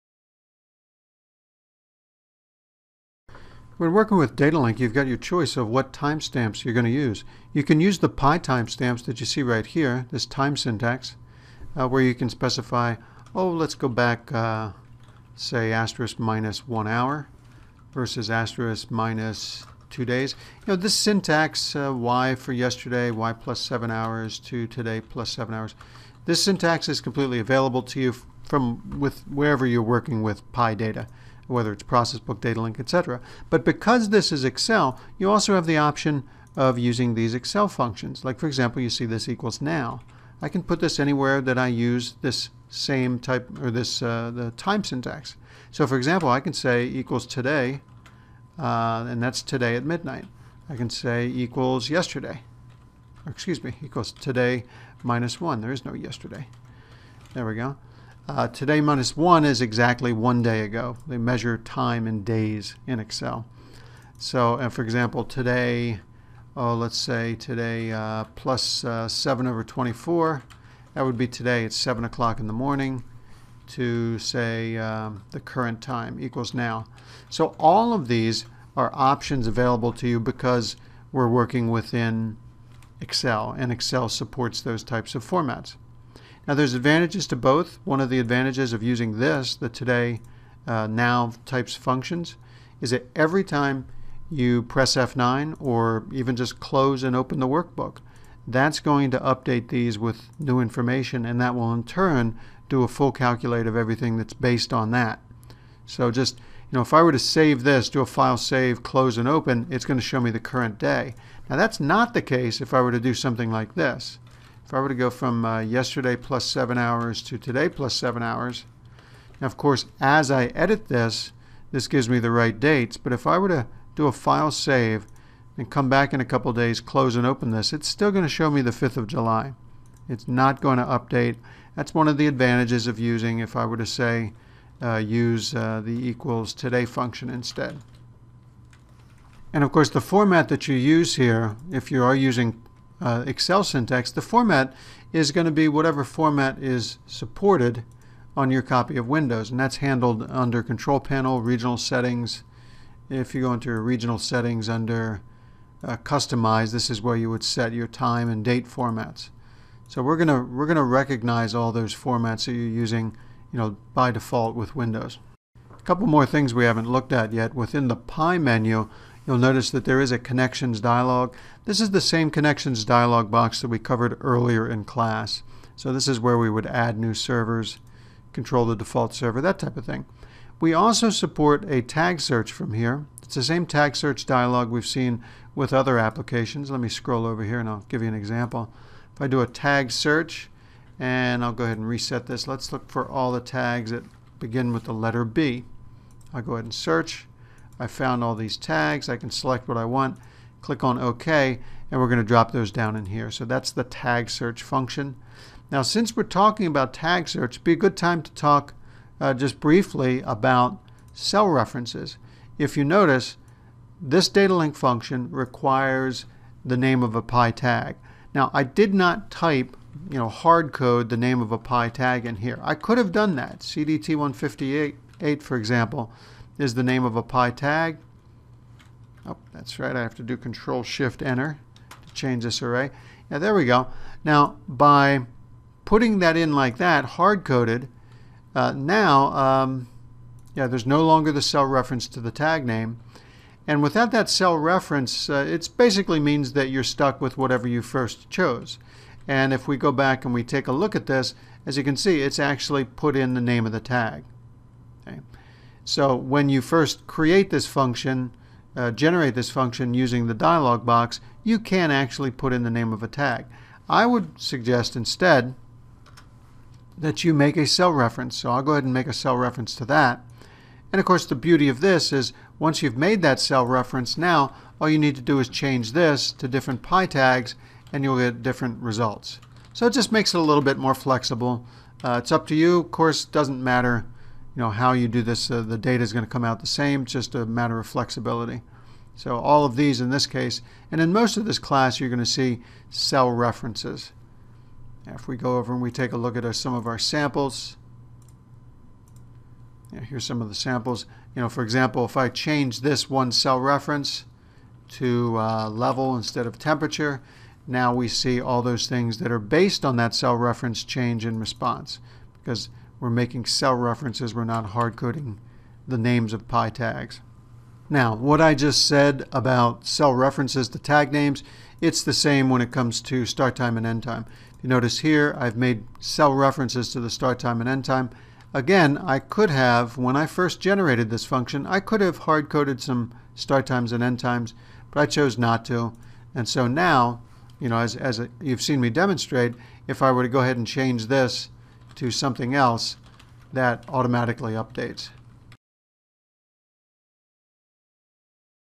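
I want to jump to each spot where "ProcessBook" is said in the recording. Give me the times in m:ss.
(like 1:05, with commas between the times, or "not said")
0:31.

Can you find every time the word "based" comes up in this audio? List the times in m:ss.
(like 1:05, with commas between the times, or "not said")
1:44, 5:09.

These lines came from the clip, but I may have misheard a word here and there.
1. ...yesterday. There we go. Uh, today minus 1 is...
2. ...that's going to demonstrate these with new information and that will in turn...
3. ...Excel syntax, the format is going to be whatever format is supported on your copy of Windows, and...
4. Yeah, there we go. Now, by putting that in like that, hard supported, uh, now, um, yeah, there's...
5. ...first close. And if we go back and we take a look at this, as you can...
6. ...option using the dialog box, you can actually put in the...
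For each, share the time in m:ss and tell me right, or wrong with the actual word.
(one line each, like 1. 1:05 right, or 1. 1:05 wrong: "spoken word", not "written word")
1. 0:55 right
2. 1:38 wrong: "update", not "demonstrate"
3. 2:23 right
4. 3:53 wrong: "coded", not "supported"
5. 4:07 wrong: "chose", not "close"
6. 4:19 wrong: "function", not "option".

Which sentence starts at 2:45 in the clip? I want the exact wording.
A couple more things we haven't looked at yet within the PI menu.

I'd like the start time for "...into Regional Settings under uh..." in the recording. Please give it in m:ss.
2:33.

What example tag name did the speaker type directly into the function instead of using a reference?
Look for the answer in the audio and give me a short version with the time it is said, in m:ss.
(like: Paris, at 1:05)
CDT158, at 3:43.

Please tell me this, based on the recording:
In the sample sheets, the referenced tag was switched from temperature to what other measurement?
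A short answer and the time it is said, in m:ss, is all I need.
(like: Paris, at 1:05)
level, at 5:05.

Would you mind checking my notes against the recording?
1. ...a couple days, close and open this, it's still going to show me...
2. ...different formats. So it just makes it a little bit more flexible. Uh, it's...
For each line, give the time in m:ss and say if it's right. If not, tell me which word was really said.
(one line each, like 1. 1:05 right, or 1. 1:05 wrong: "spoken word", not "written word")
1. 2:06 right
2. 4:38 wrong: "results", not "formats".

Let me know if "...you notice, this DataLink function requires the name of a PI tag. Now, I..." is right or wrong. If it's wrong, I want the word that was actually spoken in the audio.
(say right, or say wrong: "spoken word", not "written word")
right.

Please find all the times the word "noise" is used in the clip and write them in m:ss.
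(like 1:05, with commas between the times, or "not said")
not said.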